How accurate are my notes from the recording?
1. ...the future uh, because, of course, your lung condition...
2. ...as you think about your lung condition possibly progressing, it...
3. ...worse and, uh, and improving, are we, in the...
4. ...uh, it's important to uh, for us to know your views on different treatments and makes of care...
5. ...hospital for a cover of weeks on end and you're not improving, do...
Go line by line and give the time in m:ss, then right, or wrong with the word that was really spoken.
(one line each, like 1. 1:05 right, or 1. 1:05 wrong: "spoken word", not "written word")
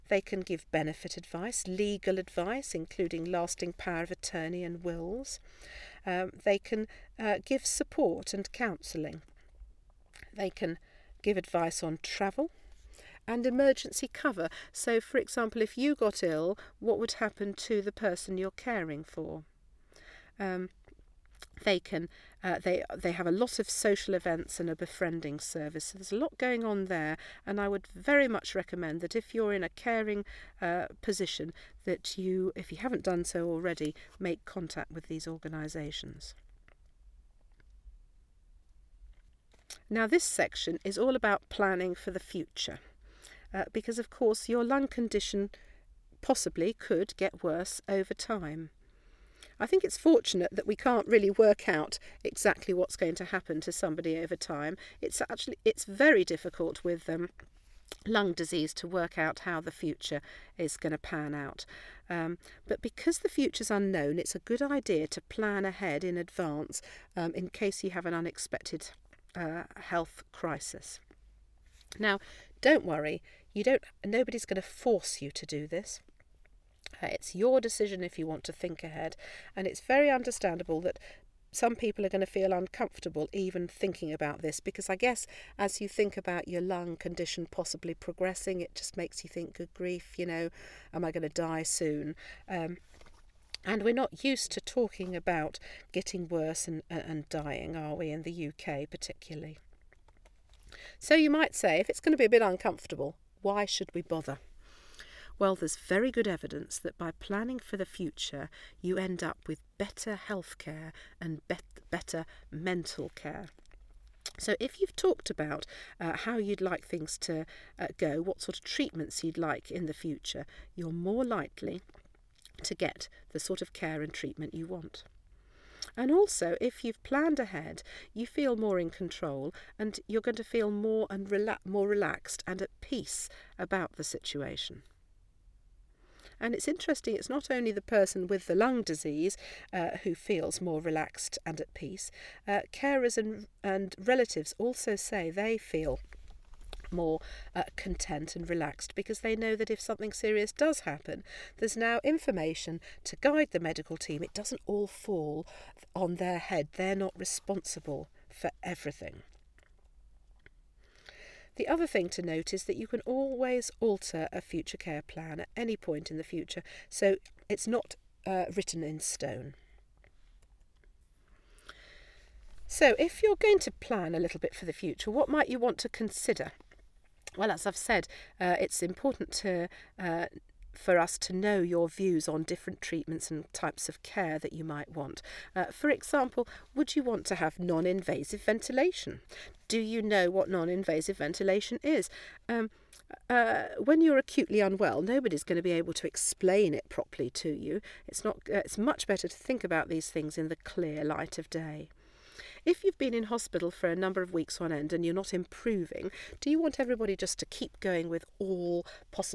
1. 0:42 right
2. 1:25 right
3. 1:36 wrong: "dying", not "improving"
4. 2:58 wrong: "types", not "makes"
5. 3:23 wrong: "number", not "cover".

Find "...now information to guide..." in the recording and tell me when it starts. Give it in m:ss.
2:31.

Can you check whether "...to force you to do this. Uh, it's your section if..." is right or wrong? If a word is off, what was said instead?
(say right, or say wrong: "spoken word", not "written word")
wrong: "decision", not "section".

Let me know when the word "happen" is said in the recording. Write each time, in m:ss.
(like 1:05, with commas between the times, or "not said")
0:17, 0:53, 2:30.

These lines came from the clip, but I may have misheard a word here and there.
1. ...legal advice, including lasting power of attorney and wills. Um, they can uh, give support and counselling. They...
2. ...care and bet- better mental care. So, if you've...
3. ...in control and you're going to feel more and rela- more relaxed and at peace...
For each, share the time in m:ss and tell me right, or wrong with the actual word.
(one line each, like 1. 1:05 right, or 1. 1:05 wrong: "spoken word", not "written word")
1. 0:01 right
2. 1:50 right
3. 2:08 right.